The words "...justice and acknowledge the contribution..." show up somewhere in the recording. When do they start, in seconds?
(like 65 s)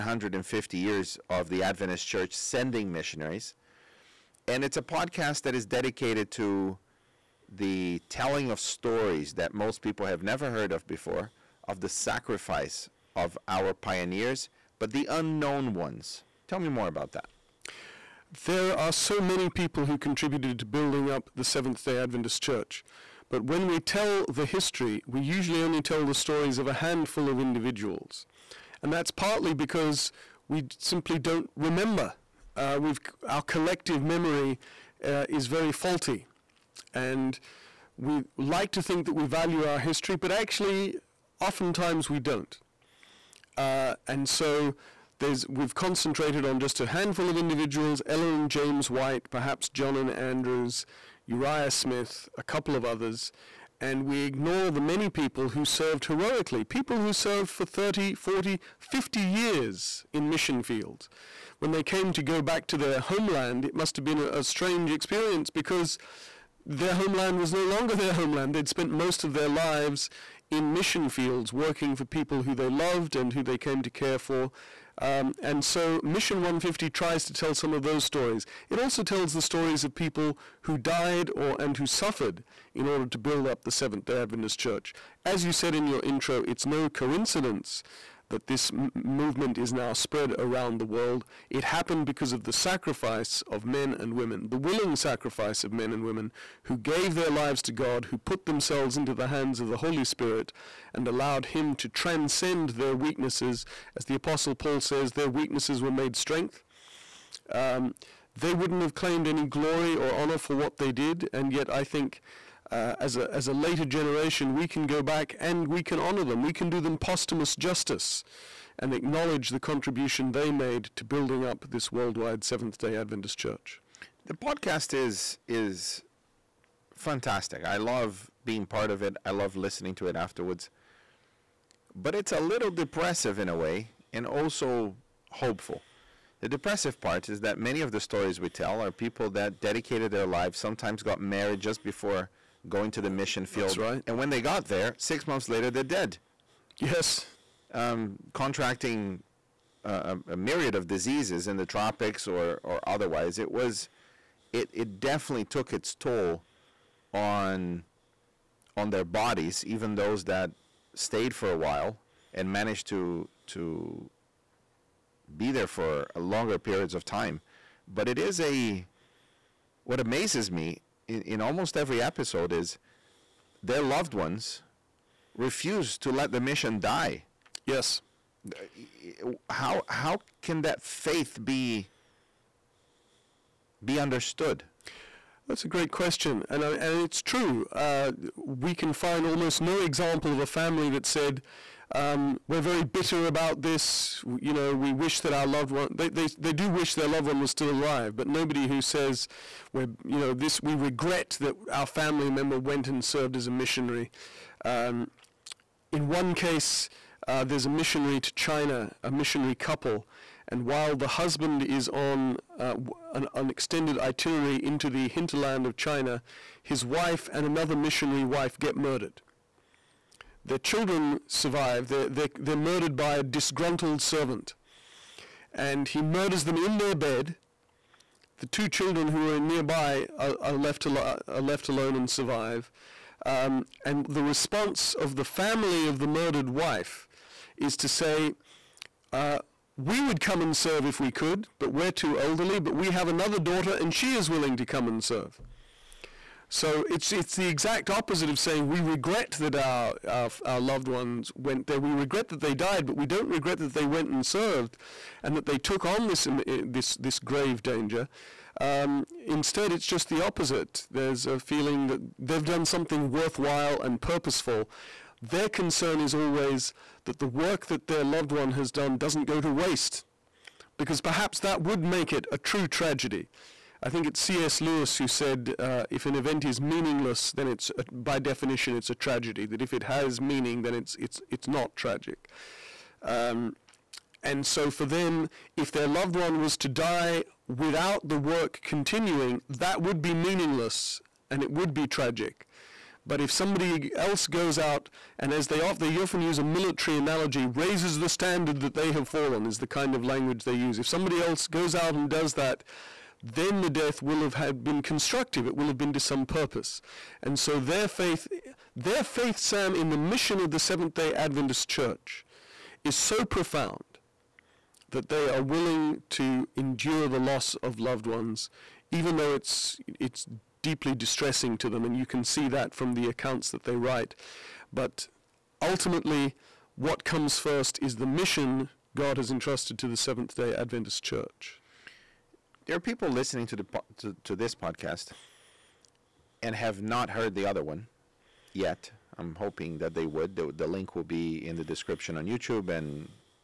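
117 s.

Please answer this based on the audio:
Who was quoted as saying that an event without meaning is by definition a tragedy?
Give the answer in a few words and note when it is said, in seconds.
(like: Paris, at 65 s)
C.S. Lewis, at 274 s.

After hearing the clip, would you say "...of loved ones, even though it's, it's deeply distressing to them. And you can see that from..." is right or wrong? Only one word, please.
right.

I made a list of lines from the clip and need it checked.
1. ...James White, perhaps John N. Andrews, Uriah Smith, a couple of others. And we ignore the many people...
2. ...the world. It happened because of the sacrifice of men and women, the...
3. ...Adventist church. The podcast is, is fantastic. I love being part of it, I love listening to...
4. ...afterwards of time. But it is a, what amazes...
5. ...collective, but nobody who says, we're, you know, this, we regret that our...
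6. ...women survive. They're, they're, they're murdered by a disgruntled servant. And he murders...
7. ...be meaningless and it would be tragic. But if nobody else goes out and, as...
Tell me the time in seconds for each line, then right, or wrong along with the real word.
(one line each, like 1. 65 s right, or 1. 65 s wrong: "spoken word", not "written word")
1. 48 s right
2. 90 s right
3. 122 s right
4. 166 s wrong: "periods", not "afterwards"
5. 197 s wrong: "alive", not "collective"
6. 220 s wrong: "children", not "women"
7. 290 s wrong: "somebody", not "nobody".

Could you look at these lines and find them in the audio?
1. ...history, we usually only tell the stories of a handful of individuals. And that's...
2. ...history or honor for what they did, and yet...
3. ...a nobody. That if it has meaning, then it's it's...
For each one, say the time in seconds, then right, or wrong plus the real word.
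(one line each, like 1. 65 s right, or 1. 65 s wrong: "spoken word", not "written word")
1. 24 s right
2. 109 s wrong: "glory", not "history"
3. 278 s wrong: "tragedy", not "nobody".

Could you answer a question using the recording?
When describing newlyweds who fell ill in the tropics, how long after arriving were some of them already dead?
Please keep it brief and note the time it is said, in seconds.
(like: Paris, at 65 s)
6 months, at 144 s.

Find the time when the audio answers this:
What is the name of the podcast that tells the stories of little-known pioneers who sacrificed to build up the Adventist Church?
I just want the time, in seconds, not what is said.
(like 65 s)
76 s.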